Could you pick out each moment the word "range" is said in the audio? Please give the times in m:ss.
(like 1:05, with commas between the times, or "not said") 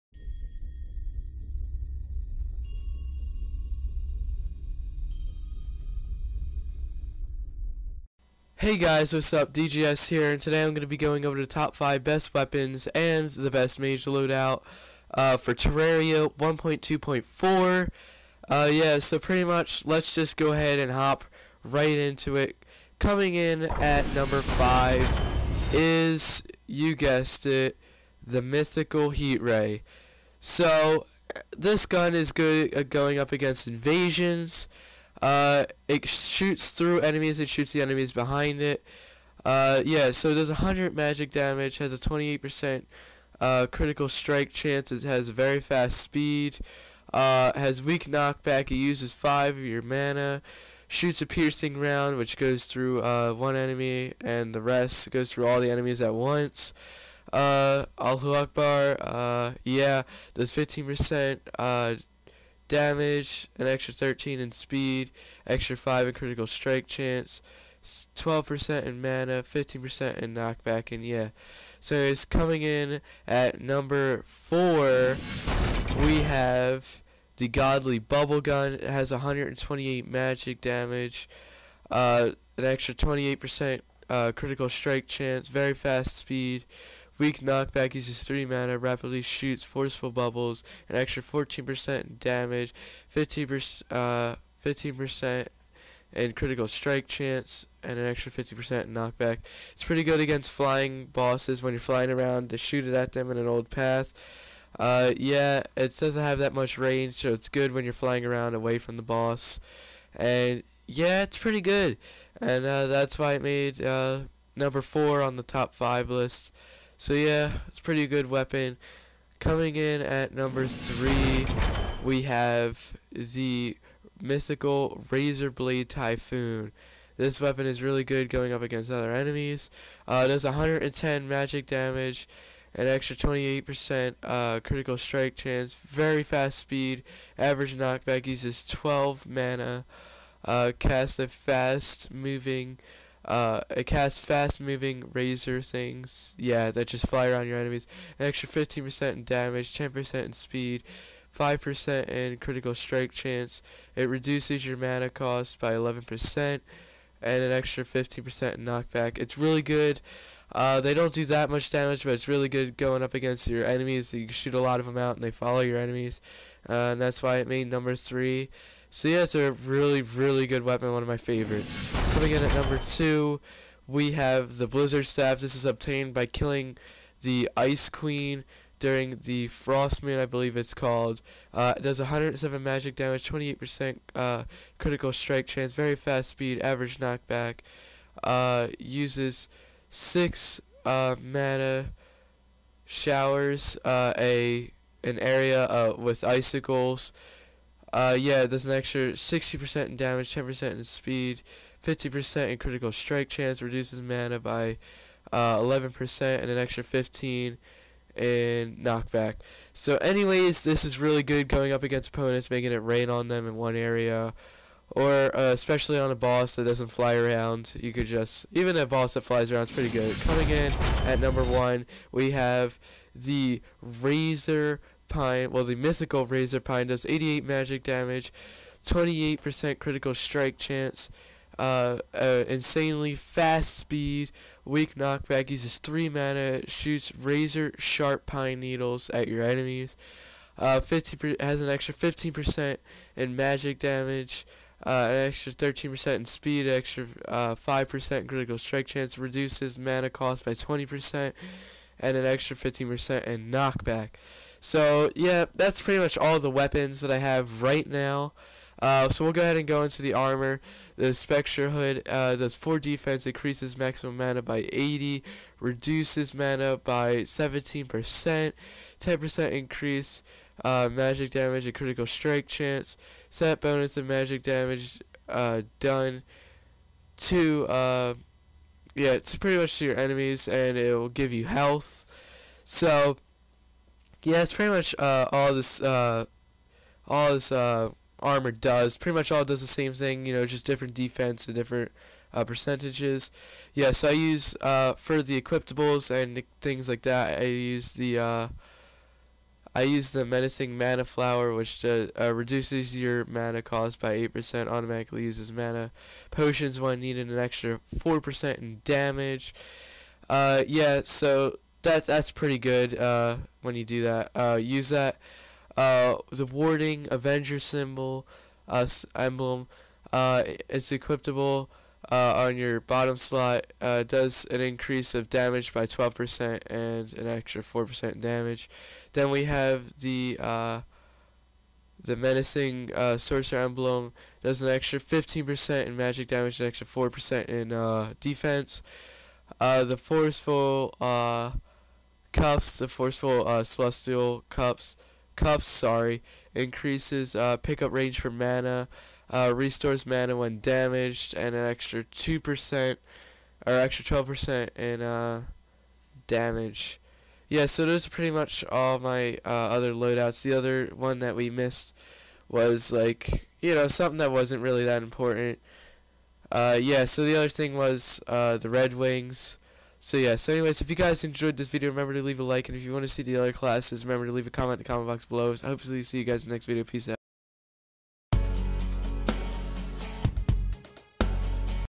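1:46, 5:47.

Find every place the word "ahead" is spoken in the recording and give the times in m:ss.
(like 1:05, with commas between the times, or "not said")
0:20, 4:19.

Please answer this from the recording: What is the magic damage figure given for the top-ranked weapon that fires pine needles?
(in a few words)
88.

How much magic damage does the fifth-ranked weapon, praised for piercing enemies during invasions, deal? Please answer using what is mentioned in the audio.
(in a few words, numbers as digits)
100.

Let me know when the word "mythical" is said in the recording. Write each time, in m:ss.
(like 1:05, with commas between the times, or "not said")
0:28, 2:04, 3:45.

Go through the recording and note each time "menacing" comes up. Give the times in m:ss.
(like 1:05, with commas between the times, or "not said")
5:00, 5:32.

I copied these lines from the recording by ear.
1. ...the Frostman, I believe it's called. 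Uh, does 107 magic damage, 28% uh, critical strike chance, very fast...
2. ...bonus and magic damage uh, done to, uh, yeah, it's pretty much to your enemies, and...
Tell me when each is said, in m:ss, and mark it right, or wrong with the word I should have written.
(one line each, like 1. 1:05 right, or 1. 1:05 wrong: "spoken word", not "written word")
1. 2:59 right
2. 4:33 right.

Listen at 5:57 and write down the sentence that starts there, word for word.
Yeah, so those are pretty much all my uh, other loadouts.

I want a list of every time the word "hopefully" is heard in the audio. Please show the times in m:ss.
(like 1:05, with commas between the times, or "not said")
6:15.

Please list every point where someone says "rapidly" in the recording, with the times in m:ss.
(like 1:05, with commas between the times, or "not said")
1:28.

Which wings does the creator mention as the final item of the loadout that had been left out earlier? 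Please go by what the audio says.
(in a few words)
Red Wings.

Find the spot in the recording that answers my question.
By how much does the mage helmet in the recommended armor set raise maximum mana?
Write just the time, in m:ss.
4:24.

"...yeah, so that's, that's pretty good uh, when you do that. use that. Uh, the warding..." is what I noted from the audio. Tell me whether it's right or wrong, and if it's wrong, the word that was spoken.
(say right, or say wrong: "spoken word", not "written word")
right.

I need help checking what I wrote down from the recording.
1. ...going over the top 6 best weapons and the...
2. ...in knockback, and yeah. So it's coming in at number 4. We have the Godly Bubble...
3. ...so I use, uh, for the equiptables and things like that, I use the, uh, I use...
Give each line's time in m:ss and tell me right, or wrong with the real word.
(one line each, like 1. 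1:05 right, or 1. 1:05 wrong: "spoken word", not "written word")
1. 0:10 wrong: "5", not "6"
2. 1:10 right
3. 4:53 right.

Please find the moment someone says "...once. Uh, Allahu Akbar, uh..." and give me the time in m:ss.
0:56.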